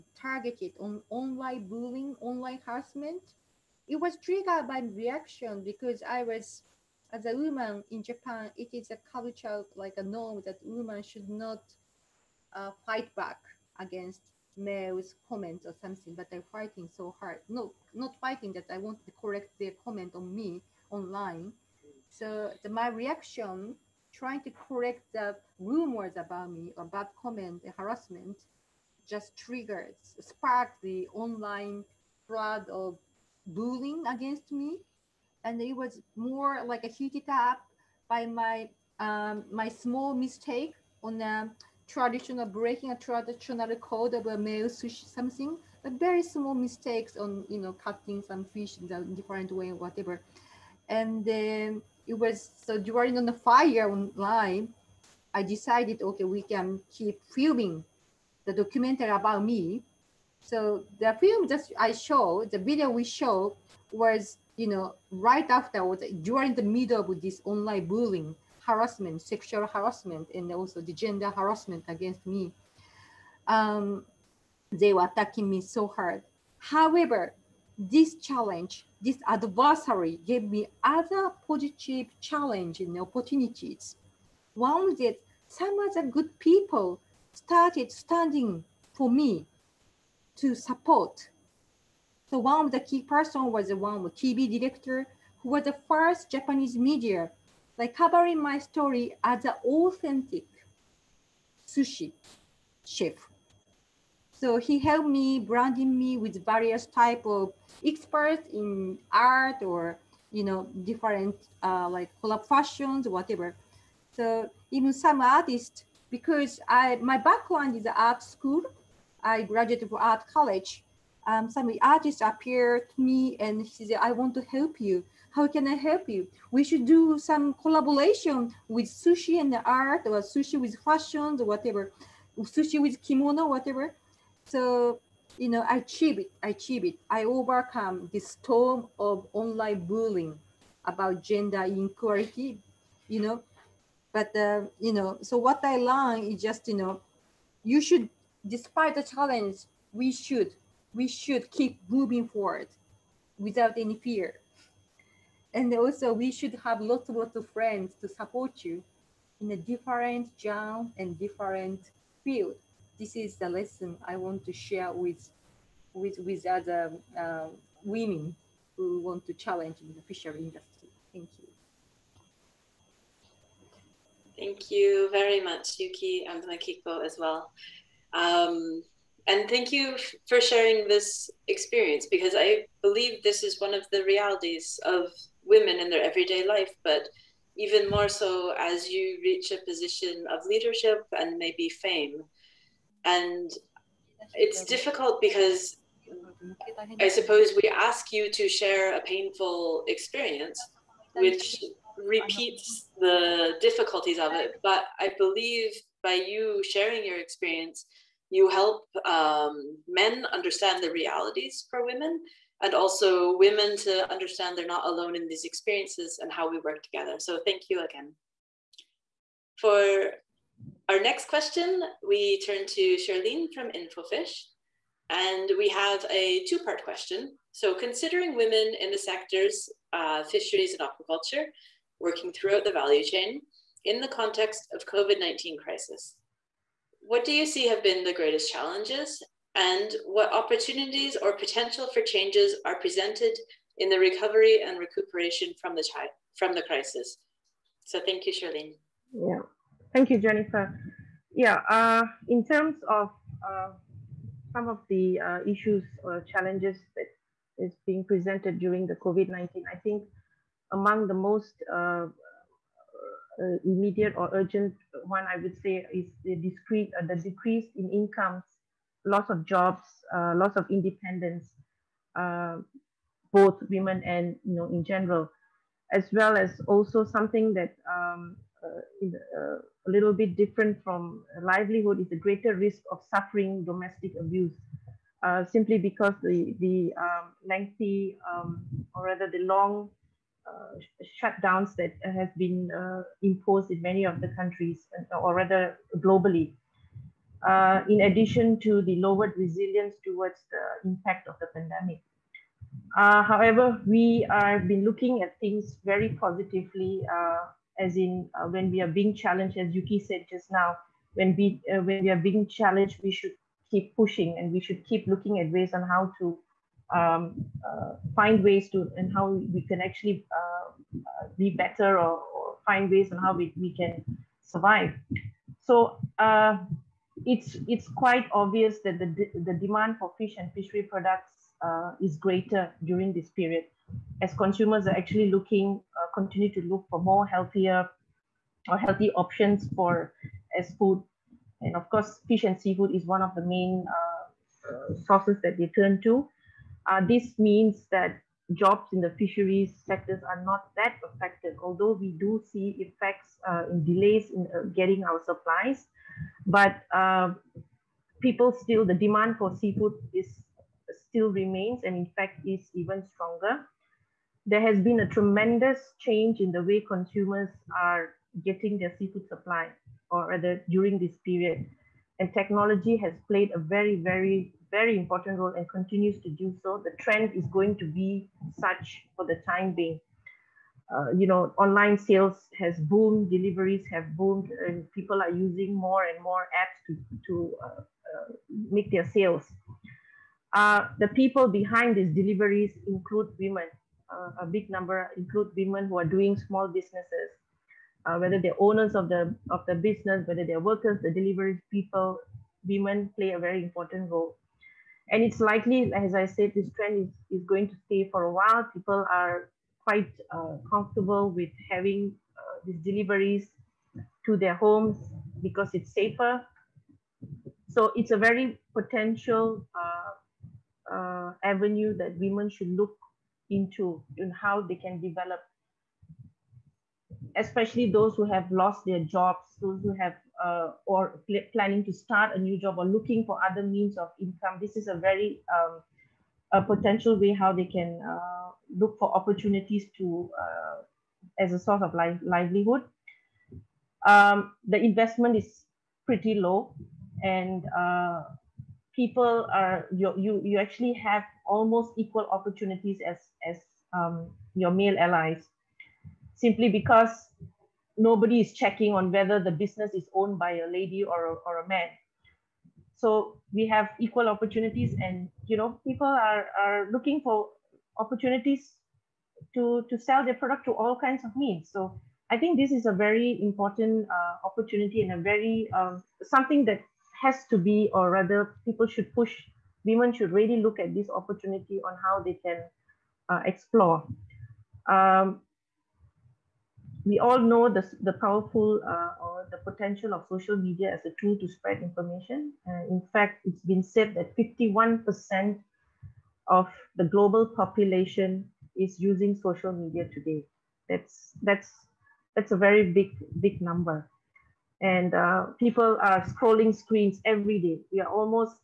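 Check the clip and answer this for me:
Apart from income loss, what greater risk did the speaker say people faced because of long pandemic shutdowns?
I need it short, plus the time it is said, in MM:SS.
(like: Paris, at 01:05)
domestic abuse, at 04:43.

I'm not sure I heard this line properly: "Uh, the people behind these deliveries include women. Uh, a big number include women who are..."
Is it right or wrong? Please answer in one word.
right.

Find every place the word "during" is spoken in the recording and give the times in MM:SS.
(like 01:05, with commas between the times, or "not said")
00:52, 04:18, 05:32, 06:10.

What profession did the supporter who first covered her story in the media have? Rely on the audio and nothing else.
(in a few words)
TV director.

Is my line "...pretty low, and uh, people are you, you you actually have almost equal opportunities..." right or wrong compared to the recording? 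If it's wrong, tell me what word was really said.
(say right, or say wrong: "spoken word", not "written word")
right.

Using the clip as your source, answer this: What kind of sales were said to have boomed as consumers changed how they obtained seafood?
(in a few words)
online sales.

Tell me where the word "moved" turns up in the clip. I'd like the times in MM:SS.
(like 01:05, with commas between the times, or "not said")
not said.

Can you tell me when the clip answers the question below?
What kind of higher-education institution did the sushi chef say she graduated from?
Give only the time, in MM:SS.
02:00.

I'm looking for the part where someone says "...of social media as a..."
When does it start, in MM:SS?
08:10.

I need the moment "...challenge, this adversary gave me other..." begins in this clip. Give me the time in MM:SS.
01:18.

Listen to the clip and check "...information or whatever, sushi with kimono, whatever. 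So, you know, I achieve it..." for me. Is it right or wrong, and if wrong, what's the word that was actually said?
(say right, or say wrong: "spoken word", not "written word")
wrong: "fashion", not "information".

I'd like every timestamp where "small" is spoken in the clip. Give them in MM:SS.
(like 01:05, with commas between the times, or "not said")
00:39, 00:46, 06:36.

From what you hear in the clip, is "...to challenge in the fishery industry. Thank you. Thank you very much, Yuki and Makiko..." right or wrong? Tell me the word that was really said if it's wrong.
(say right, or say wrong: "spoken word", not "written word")
right.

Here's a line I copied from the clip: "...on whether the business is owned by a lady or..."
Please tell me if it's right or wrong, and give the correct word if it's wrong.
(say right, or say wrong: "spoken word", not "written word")
right.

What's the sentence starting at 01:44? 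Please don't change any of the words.
So he helped me branding me with various type of experts in art or you know different uh, like fashions whatever.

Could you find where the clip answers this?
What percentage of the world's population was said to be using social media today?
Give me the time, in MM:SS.
08:14.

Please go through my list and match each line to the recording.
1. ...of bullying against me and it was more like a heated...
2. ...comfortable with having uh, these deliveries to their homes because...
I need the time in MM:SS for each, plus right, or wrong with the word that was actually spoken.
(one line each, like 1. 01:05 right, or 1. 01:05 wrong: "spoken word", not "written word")
1. 00:32 right
2. 06:50 right.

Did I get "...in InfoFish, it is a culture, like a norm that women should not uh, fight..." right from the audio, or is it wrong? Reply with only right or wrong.
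wrong.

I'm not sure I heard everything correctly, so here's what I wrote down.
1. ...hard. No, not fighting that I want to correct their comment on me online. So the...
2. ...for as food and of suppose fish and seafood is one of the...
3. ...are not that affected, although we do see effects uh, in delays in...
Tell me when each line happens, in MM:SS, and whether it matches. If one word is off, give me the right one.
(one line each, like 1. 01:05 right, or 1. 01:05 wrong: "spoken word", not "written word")
1. 00:17 right
2. 05:39 wrong: "course", not "suppose"
3. 05:50 right.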